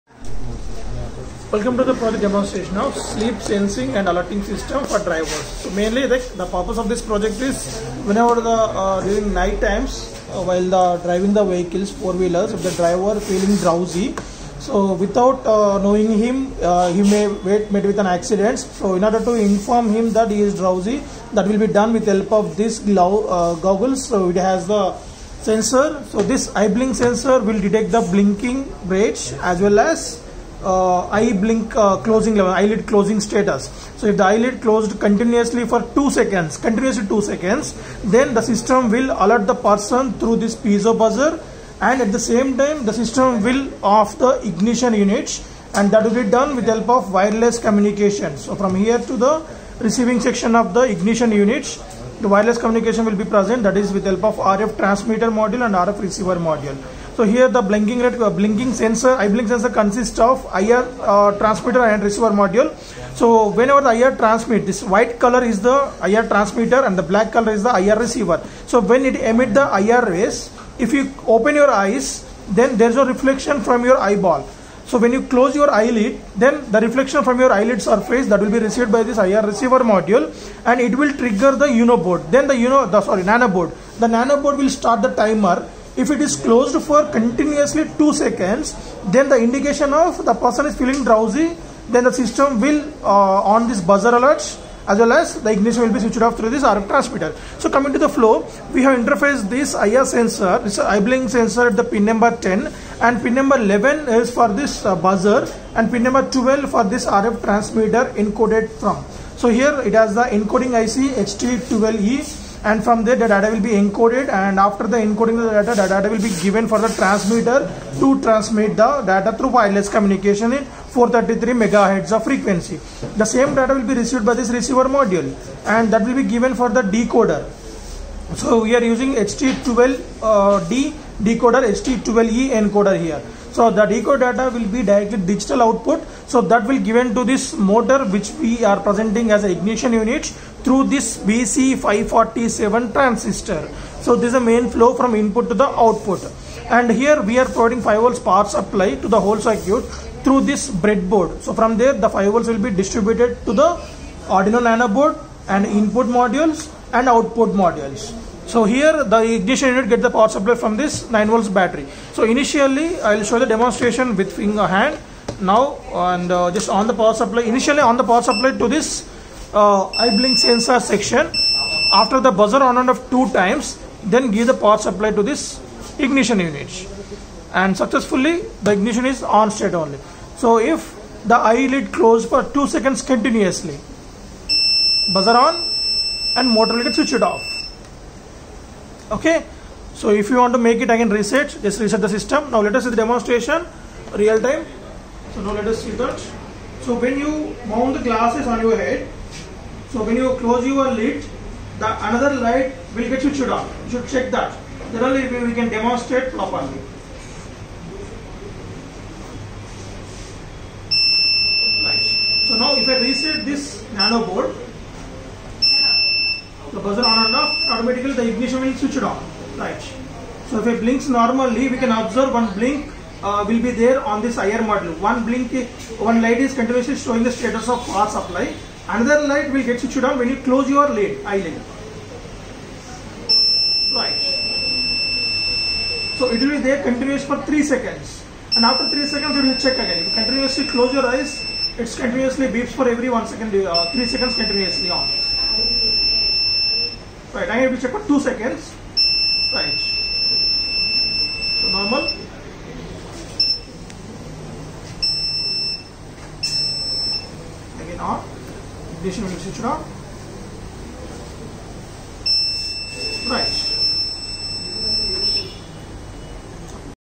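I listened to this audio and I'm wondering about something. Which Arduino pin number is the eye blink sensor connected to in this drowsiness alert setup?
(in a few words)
10.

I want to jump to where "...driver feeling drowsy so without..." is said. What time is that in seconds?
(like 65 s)
12 s.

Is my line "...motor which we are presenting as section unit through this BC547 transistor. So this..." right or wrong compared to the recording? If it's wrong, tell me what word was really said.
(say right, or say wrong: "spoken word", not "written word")
wrong: "ignition", not "section".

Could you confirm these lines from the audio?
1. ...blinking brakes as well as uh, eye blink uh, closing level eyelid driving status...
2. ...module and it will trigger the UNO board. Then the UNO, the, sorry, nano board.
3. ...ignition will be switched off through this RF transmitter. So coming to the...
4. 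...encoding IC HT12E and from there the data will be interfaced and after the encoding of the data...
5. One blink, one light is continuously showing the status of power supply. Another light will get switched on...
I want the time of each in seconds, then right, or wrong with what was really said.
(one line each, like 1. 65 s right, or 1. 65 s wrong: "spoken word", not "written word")
1. 28 s wrong: "closing", not "driving"
2. 79 s right
3. 95 s right
4. 110 s wrong: "encoded", not "interfaced"
5. 224 s right.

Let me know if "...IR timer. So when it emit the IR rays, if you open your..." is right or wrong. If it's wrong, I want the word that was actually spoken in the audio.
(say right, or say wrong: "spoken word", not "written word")
wrong: "receiver", not "timer".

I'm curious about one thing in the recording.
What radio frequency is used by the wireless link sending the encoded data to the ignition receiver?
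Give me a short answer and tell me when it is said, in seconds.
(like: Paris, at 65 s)
433 megahertz, at 120 s.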